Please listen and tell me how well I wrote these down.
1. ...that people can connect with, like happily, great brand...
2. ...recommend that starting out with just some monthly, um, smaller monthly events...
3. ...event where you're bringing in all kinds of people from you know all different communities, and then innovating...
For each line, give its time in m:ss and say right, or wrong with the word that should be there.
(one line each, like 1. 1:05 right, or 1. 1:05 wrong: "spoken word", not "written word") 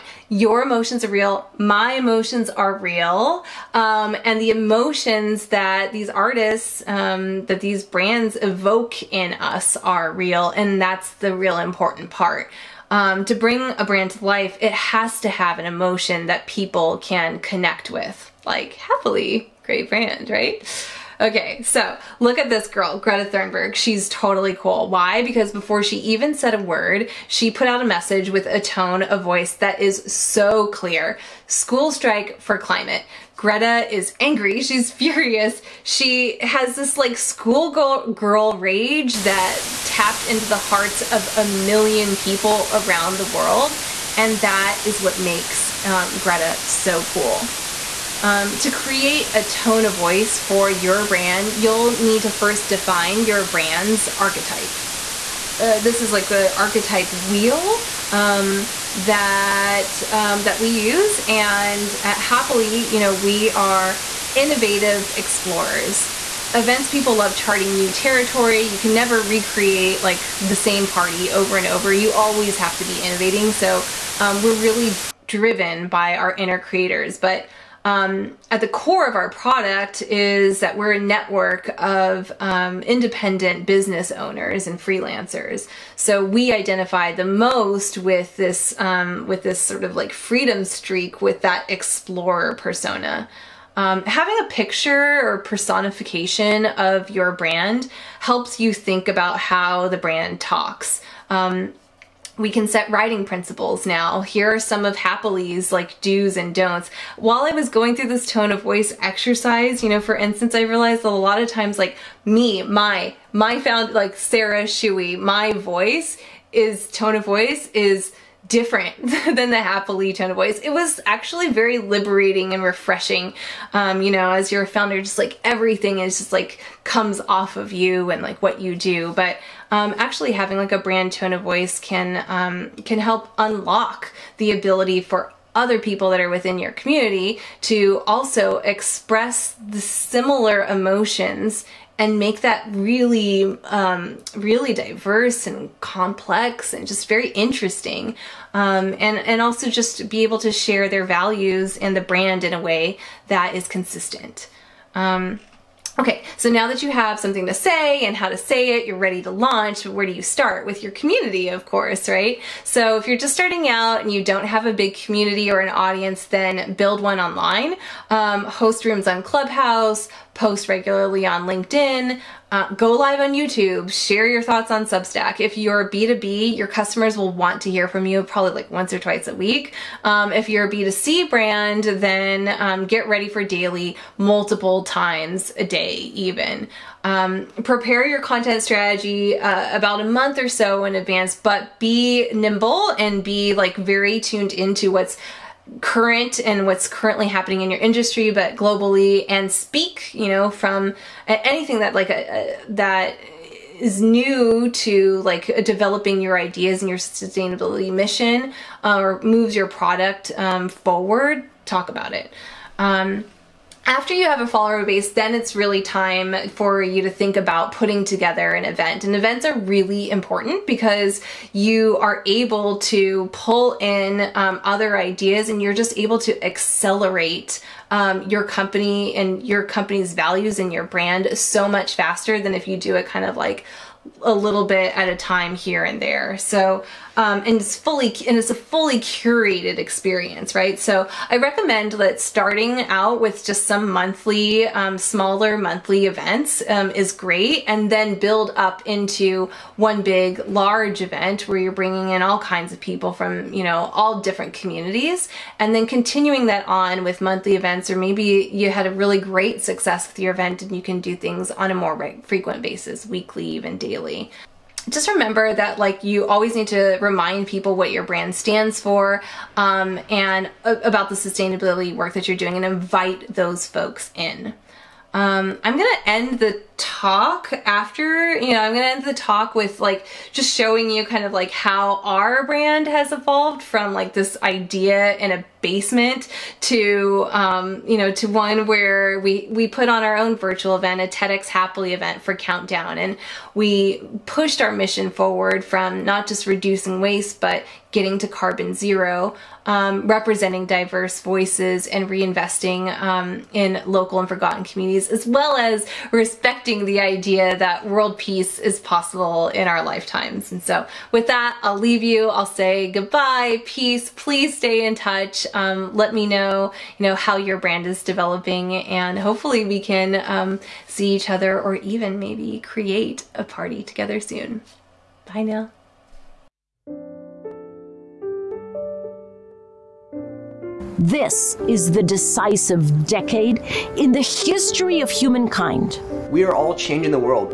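1. 0:16 right
2. 4:01 right
3. 4:11 wrong: "continuing", not "innovating".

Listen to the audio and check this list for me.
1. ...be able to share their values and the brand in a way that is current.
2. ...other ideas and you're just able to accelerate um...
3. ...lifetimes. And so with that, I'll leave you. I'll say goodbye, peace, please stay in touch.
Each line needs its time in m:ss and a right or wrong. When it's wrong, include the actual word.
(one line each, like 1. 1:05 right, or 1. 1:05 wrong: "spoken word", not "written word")
1. 2:30 wrong: "consistent", not "current"
2. 3:44 right
3. 5:09 right.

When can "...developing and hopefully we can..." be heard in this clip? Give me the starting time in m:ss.
5:18.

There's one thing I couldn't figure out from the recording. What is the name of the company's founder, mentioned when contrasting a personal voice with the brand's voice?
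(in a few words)
Sarah Shewey.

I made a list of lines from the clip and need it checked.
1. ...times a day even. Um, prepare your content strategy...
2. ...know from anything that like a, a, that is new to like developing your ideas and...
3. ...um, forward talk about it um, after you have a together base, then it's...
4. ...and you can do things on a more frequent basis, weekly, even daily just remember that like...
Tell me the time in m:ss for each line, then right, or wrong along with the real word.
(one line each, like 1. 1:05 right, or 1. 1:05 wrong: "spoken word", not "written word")
1. 3:04 right
2. 3:20 right
3. 3:30 wrong: "follower", not "together"
4. 4:20 right.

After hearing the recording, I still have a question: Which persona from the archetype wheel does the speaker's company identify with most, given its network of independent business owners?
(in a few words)
Explorer.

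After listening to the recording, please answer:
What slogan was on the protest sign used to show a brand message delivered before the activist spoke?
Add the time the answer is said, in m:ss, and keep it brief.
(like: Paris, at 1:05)
School strike for climate, at 0:31.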